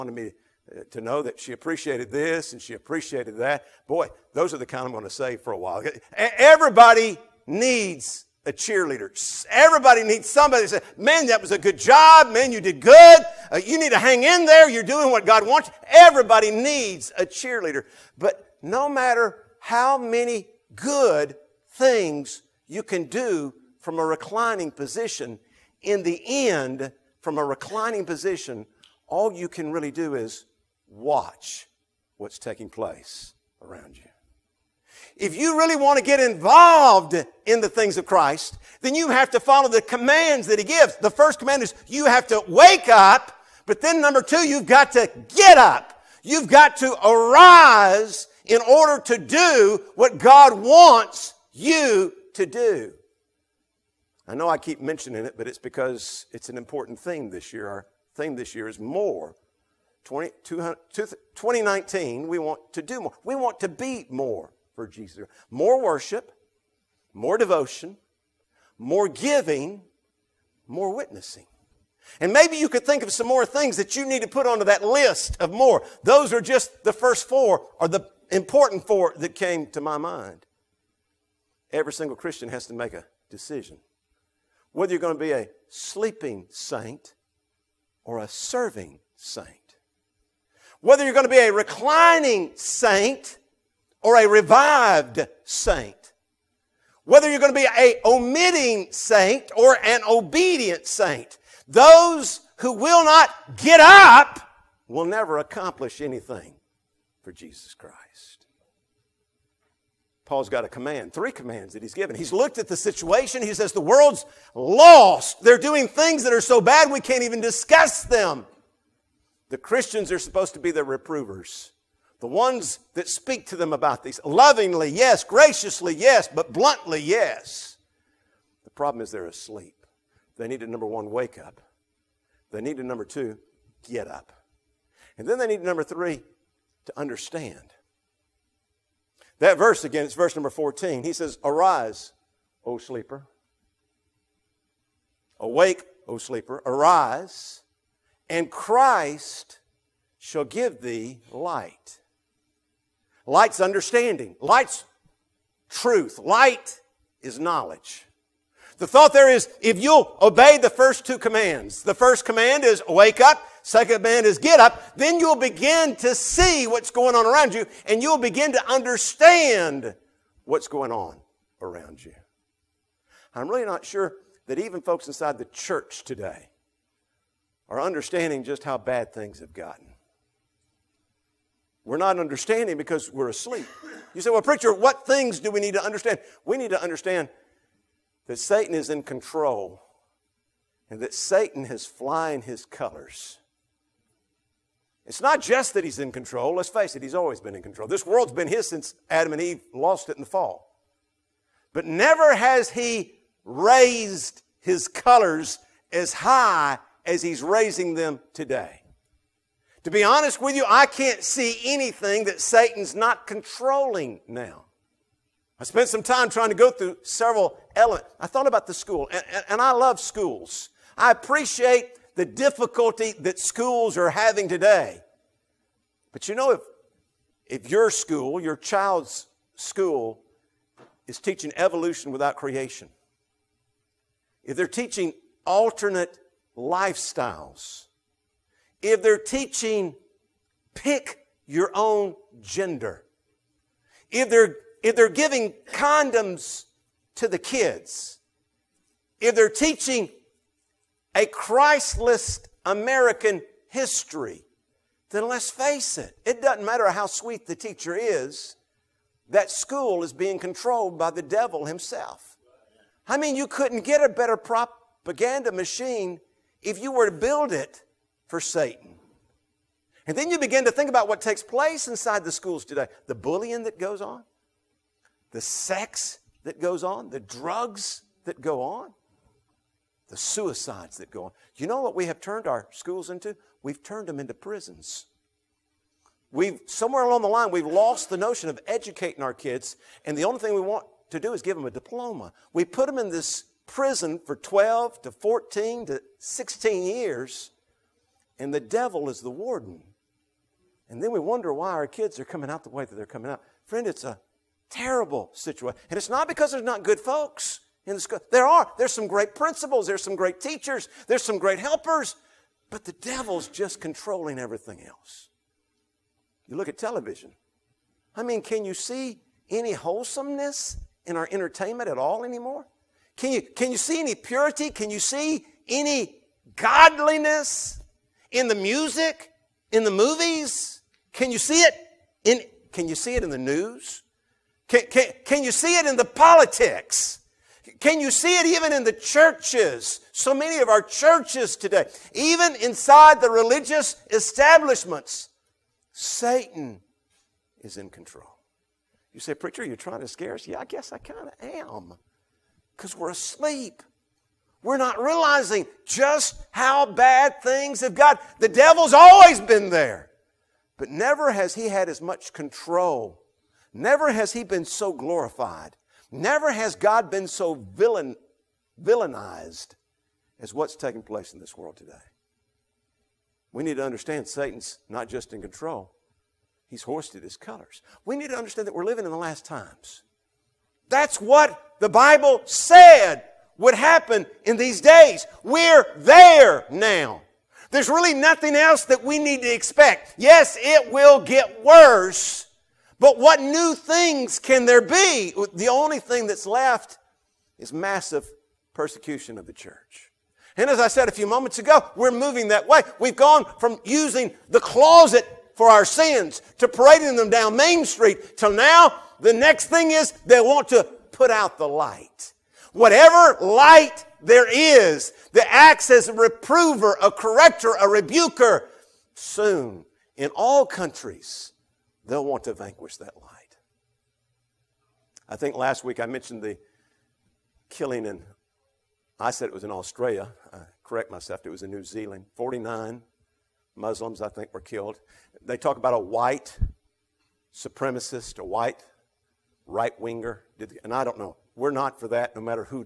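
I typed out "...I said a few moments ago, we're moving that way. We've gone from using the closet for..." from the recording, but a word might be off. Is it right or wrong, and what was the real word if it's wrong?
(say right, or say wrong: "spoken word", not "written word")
right.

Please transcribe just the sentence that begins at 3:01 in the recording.
We're not understanding because we're asleep.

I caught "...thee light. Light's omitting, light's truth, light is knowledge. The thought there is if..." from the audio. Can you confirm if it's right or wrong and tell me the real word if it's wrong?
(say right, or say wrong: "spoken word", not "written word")
wrong: "understanding", not "omitting".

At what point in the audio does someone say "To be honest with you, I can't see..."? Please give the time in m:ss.
3:29.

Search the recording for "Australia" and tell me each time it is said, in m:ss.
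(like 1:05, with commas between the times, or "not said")
7:09.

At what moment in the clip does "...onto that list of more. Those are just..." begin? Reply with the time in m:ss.
1:14.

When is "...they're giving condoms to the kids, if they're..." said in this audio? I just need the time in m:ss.
4:04.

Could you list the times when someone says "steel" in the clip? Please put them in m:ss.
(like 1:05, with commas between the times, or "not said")
not said.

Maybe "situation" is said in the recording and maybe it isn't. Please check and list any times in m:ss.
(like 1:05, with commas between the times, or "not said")
1:52, 5:05.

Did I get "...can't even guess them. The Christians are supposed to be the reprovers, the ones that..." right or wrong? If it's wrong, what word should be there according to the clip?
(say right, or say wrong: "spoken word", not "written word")
wrong: "discuss", not "guess".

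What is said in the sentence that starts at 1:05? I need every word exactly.
More worship, more devotion, more giving, more witnessing.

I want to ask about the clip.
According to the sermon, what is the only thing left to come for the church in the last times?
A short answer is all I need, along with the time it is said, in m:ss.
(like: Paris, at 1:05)
Massive persecution, at 6:37.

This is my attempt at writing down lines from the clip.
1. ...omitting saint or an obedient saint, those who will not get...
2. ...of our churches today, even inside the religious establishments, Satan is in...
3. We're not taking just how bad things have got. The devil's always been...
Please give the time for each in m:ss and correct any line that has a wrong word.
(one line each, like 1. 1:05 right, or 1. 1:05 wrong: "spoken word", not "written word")
1. 1:38 right
2. 5:40 right
3. 5:54 wrong: "realizing", not "taking".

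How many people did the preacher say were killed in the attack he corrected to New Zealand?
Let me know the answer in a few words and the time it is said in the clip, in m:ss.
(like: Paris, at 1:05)
49, at 7:12.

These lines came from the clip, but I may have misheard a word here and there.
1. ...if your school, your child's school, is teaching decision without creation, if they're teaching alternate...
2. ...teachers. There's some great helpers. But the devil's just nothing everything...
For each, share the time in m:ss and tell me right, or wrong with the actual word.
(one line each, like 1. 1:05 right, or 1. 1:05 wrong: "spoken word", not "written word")
1. 3:47 wrong: "evolution", not "decision"
2. 5:10 wrong: "controlling", not "nothing".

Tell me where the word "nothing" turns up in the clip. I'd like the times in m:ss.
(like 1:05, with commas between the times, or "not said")
6:28.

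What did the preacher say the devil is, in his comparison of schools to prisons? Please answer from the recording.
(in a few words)
The warden.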